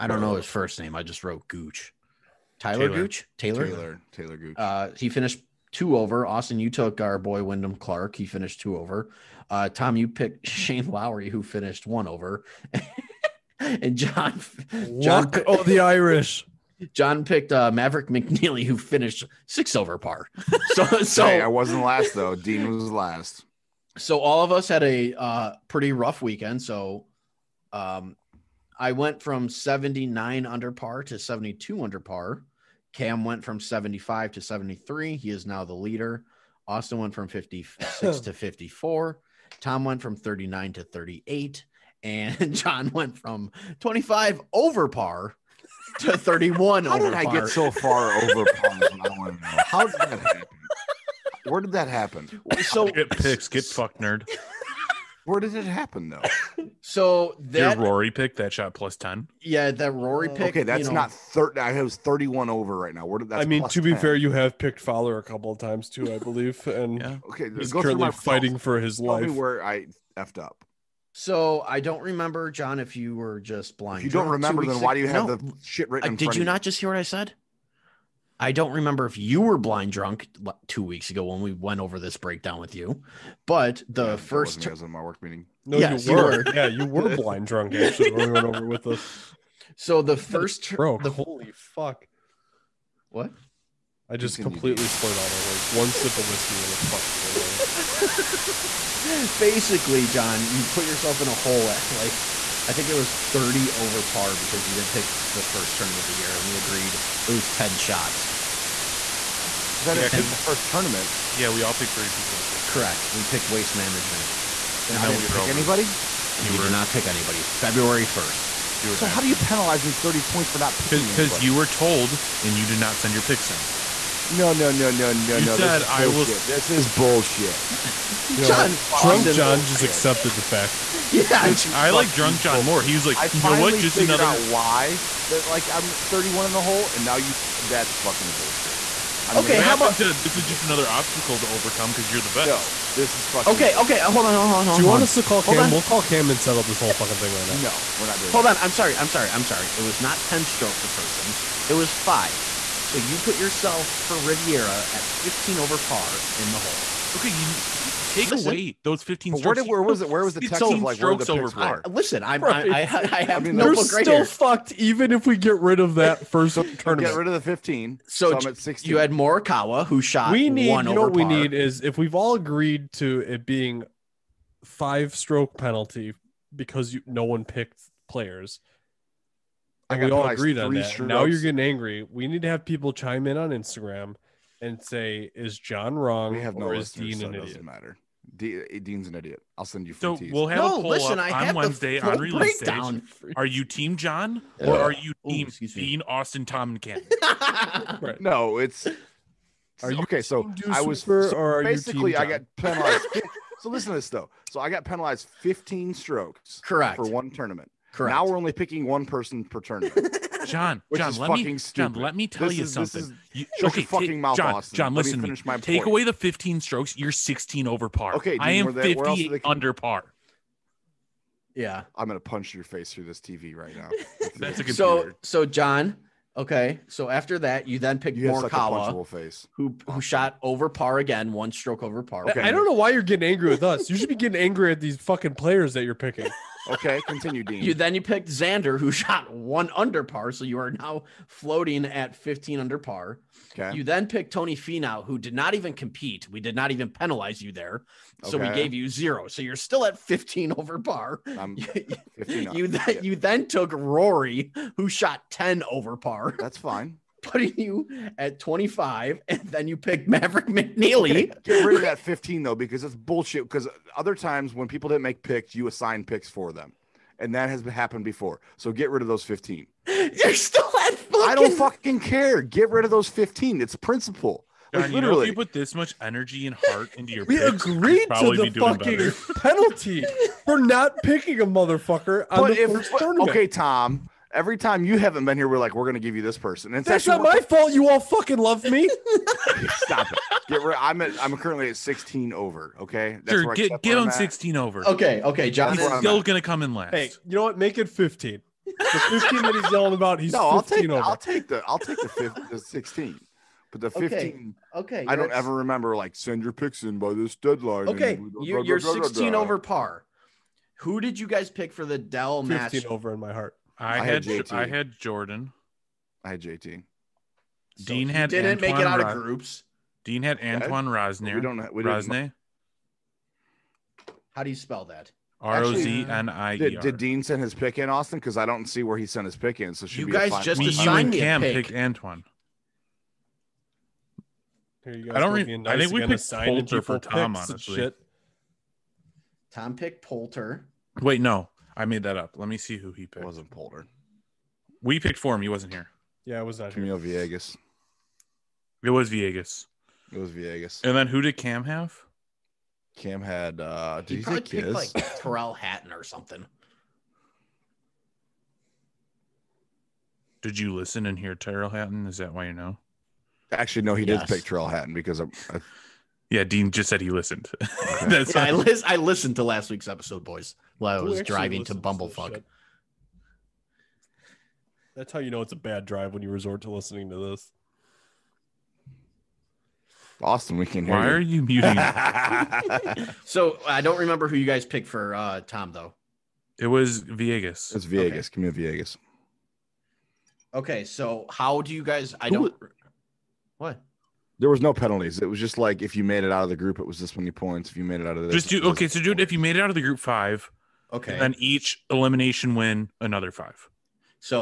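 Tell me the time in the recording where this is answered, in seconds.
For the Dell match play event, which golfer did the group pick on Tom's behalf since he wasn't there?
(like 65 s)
346 s.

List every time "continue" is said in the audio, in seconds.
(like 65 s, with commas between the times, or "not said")
94 s, 237 s.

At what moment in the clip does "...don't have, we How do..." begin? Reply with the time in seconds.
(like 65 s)
321 s.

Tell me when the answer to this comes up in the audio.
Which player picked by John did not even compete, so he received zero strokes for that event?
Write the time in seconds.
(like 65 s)
244 s.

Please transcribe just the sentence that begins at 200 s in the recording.
So I was so or basically I got penalized.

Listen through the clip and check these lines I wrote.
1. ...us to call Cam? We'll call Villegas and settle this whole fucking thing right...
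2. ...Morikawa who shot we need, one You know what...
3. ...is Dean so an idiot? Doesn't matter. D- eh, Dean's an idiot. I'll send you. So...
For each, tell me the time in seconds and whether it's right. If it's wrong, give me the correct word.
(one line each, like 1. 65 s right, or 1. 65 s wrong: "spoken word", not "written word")
1. 145 s wrong: "Cam", not "Villegas"
2. 169 s right
3. 186 s right.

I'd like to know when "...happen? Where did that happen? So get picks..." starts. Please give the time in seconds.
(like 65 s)
50 s.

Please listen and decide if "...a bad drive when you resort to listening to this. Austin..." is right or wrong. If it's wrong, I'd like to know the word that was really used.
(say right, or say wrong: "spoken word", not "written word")
right.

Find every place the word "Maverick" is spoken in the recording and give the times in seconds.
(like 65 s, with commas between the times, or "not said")
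17 s, 260 s.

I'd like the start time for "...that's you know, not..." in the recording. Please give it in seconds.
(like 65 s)
60 s.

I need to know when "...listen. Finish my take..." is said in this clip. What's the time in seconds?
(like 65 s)
215 s.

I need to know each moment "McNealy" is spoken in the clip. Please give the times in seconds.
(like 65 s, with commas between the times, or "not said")
18 s, 260 s.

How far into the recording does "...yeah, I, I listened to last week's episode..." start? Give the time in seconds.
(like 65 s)
368 s.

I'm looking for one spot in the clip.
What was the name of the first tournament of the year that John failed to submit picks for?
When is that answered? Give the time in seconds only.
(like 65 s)
113 s.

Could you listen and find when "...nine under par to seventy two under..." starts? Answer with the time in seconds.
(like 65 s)
30 s.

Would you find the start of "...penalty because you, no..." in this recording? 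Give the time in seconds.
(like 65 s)
175 s.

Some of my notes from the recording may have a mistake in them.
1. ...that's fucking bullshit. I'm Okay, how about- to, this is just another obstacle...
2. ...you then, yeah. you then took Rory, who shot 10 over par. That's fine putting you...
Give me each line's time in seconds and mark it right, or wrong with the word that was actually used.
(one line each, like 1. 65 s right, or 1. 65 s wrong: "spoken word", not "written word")
1. 137 s right
2. 252 s right.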